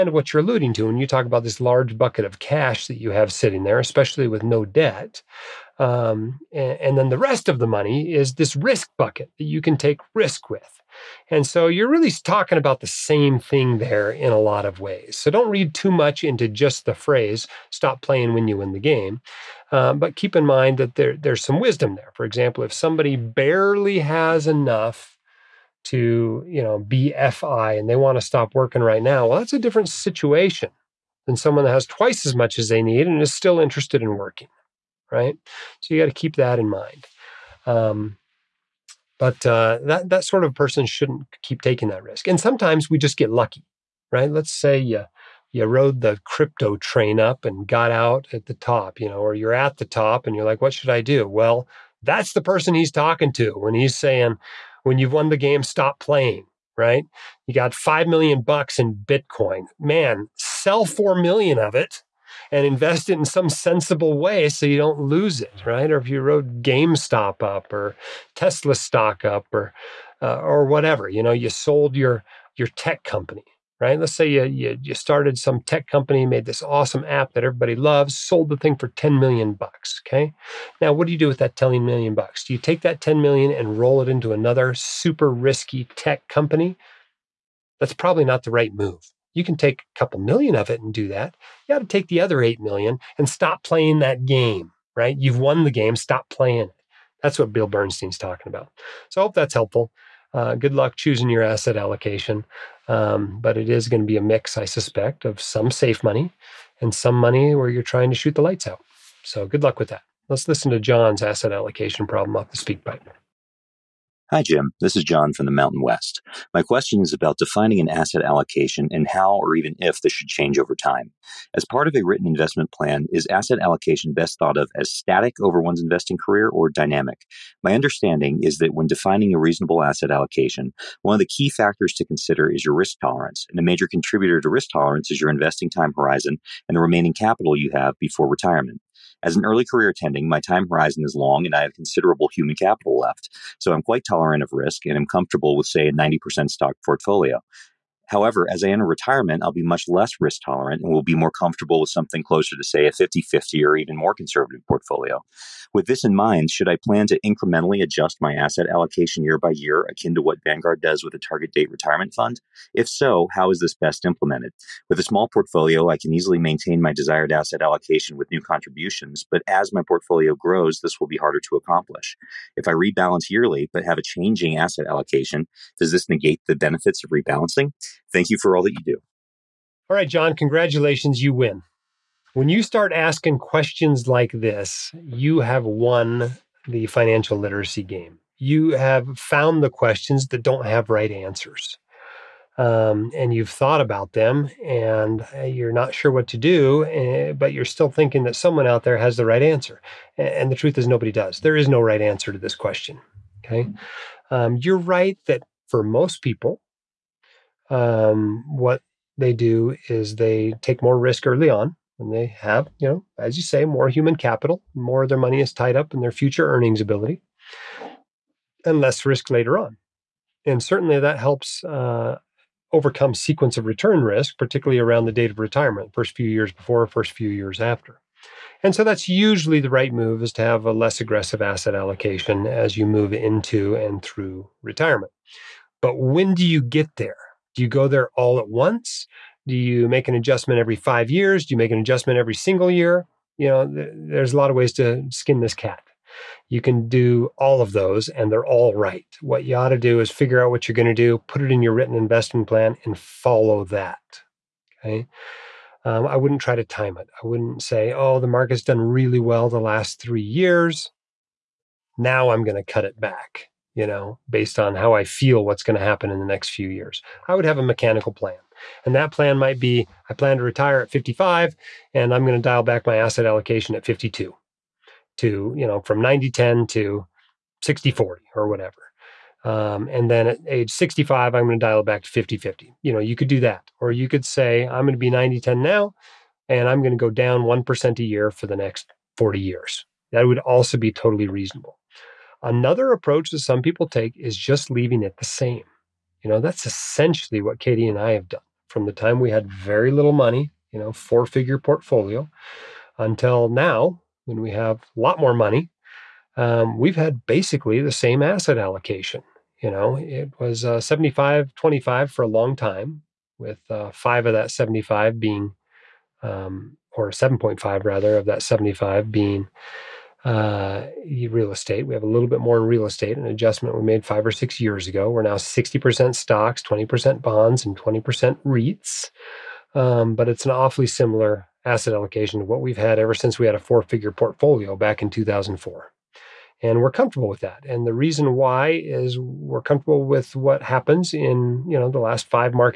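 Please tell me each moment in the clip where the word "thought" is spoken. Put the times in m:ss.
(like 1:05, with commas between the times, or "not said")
2:04, 3:13.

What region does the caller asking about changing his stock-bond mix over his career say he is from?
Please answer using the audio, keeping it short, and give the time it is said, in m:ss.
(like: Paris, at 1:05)
the Mountain West, at 1:55.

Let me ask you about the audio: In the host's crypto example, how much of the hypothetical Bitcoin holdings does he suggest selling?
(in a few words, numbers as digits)
4 million.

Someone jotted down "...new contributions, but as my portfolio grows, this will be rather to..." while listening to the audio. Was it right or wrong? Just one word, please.
wrong.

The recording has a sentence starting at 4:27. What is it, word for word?
I would have a mechanical plan.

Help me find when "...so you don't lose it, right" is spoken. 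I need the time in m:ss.
1:04.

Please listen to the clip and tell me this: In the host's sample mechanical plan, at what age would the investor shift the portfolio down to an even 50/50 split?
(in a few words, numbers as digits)
65.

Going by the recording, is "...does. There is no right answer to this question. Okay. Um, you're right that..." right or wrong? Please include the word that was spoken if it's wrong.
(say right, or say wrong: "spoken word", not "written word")
right.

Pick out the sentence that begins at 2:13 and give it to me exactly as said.
And a major contributor to risk tolerance is your investing time horizon and the remaining capital you have before retirement.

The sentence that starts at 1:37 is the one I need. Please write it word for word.
That's what Bill Bernstein's talking about.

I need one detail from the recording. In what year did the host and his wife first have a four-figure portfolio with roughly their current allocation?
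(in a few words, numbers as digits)
2004.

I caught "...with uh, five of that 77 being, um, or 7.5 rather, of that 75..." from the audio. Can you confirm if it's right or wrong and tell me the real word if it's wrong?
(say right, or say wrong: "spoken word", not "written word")
wrong: "75", not "77".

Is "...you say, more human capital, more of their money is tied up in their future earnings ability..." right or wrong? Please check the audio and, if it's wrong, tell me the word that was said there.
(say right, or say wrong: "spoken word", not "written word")
right.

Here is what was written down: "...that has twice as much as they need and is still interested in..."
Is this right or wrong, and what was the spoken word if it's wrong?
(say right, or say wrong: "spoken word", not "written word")
right.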